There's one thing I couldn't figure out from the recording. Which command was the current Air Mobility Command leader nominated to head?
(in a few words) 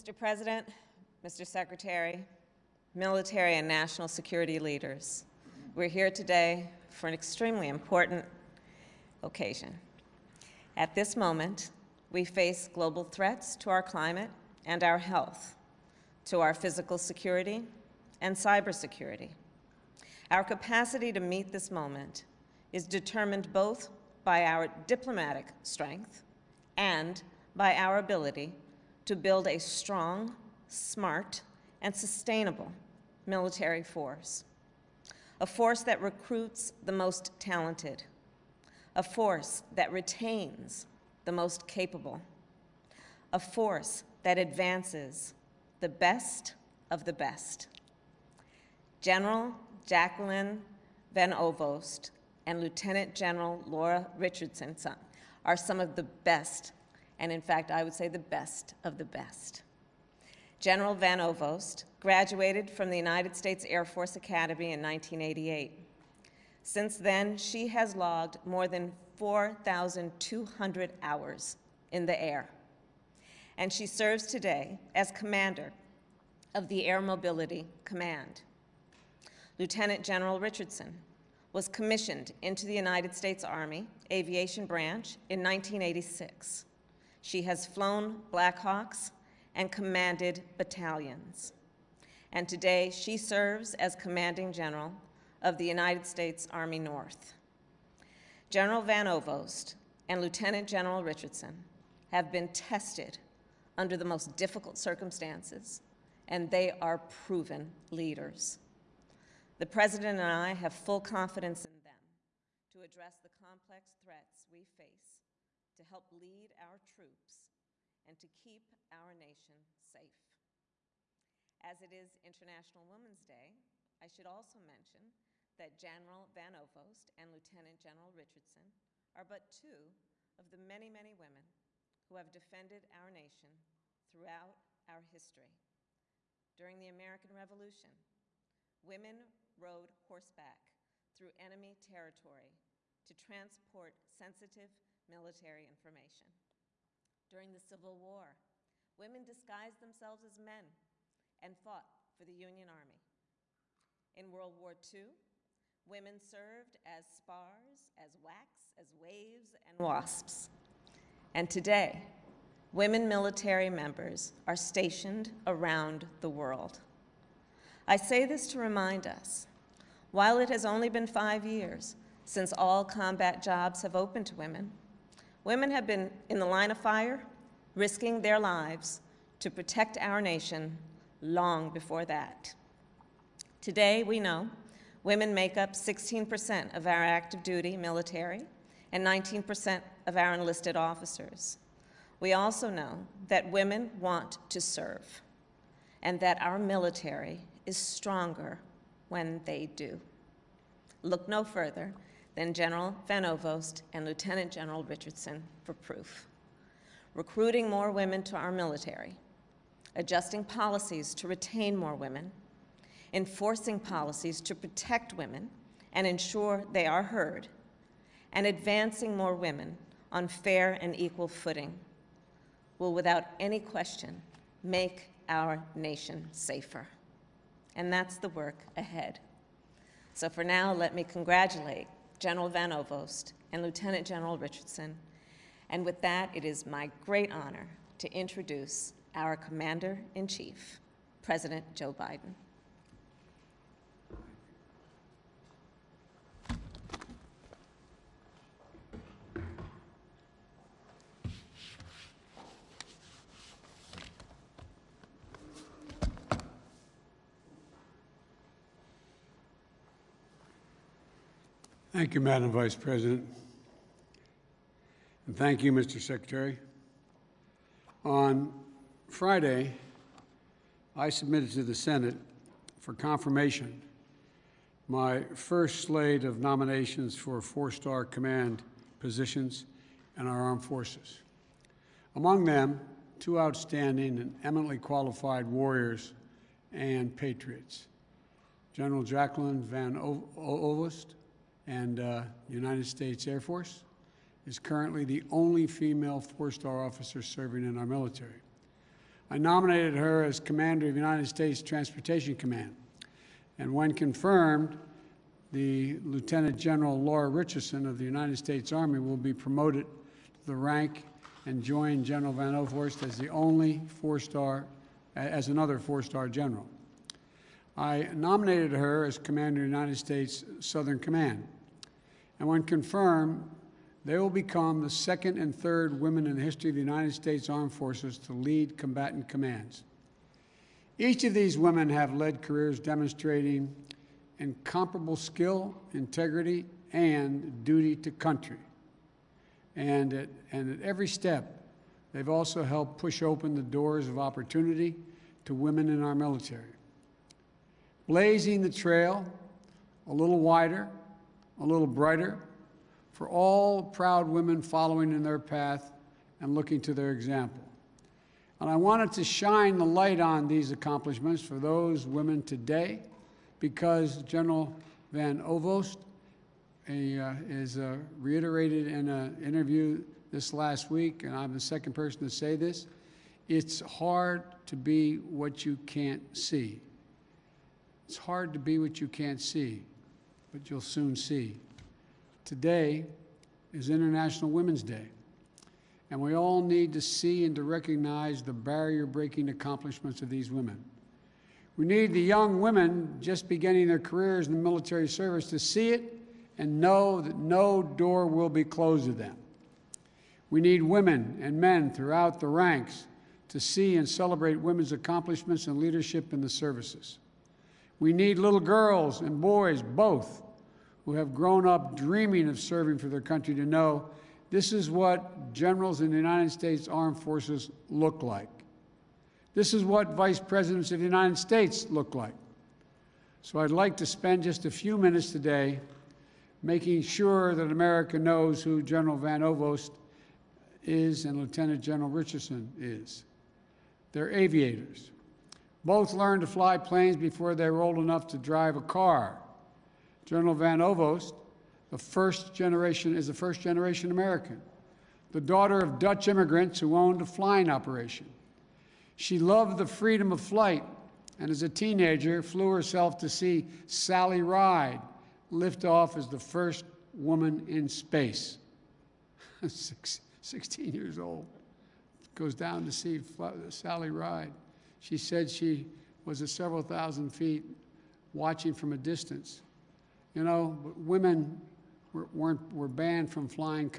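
United States Transportation Command.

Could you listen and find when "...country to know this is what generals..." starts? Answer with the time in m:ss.
6:53.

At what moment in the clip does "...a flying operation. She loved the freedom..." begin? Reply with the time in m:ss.
7:27.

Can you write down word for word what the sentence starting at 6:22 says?
Today is International Women's Day, and we all need to see and to recognize the barrier breaking accomplishments of these women.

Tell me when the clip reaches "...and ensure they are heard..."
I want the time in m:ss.
3:35.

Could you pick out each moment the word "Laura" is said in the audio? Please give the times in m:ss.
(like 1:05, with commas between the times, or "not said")
0:53, 5:06.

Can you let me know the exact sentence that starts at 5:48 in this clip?
Blazing the trail a little wider a little brighter for all proud women following in their path and looking to their example.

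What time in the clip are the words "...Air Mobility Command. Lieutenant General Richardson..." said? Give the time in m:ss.
1:16.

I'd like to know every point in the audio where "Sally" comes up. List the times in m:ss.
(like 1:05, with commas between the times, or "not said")
7:33, 7:43.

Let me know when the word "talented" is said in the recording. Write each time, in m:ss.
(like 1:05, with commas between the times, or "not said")
0:37.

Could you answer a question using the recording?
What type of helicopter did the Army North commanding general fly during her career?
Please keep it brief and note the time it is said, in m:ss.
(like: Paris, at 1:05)
Blackhawks, at 1:28.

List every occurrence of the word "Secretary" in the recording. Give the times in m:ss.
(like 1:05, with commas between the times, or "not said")
0:01, 4:25.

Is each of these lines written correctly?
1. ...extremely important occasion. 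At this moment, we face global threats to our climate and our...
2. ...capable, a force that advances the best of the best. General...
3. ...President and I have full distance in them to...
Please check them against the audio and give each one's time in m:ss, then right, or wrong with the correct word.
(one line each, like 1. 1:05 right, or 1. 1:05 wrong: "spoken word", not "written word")
1. 0:07 right
2. 0:41 right
3. 1:49 wrong: "confidence", not "distance".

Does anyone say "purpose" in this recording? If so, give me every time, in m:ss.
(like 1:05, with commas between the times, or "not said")
not said.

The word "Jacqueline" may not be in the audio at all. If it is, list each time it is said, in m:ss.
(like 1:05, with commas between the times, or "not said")
0:49, 4:49.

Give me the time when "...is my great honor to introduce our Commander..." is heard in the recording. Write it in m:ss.
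3:56.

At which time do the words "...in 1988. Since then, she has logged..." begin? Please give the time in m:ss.
1:04.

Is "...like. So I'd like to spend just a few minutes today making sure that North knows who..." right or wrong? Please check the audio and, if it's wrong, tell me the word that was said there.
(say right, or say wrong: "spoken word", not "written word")
wrong: "America", not "North".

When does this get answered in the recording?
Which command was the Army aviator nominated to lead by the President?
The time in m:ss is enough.
5:19.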